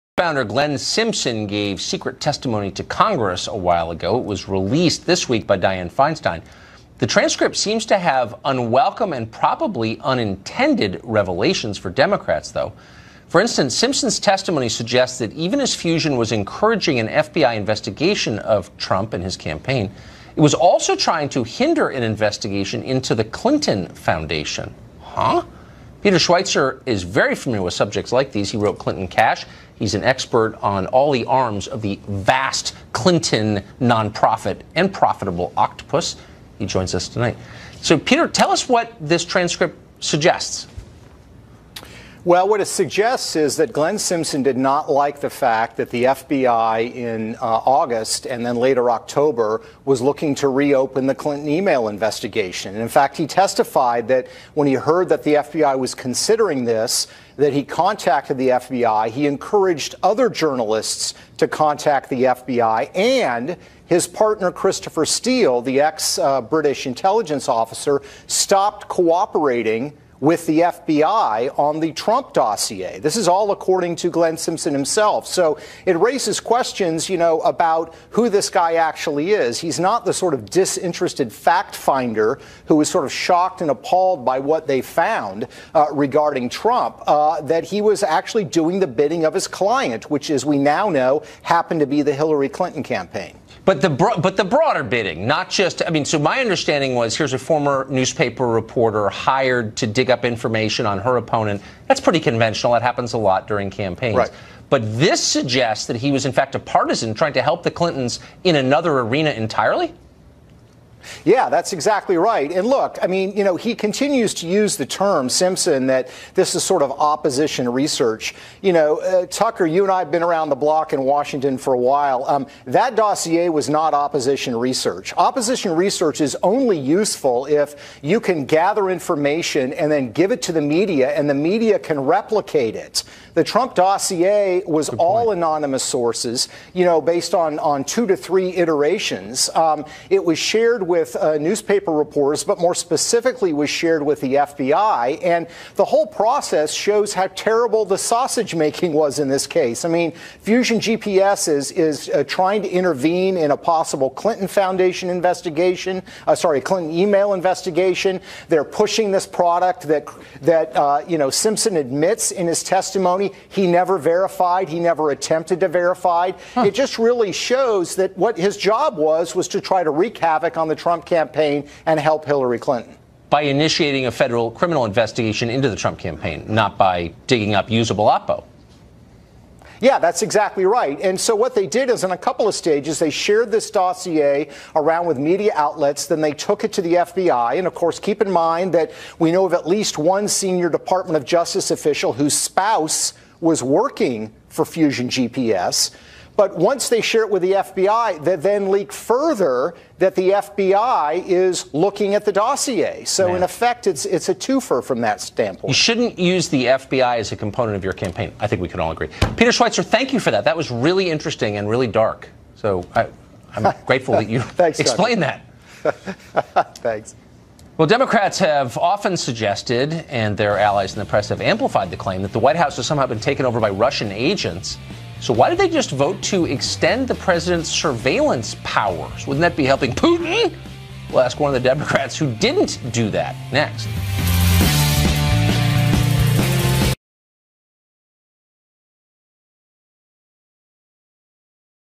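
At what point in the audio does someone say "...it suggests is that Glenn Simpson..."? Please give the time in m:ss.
0:42.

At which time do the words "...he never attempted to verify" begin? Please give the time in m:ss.
2:44.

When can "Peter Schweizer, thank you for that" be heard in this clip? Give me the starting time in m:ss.
3:29.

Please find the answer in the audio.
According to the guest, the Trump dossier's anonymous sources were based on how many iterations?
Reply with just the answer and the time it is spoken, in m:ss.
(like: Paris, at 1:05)
2 to 3, at 2:17.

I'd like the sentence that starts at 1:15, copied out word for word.
So it raises questions, you know, about who this guy actually is.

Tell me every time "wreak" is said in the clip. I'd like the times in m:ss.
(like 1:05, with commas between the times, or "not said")
2:49.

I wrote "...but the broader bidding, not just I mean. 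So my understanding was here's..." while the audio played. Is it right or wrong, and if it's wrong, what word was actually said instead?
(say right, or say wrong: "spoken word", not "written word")
right.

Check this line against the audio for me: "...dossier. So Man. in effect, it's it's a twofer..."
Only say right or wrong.
right.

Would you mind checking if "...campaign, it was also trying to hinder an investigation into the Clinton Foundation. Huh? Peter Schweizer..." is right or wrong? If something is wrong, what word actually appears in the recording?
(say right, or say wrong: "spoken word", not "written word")
right.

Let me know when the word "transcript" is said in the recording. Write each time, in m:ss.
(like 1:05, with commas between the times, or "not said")
0:07, 0:39.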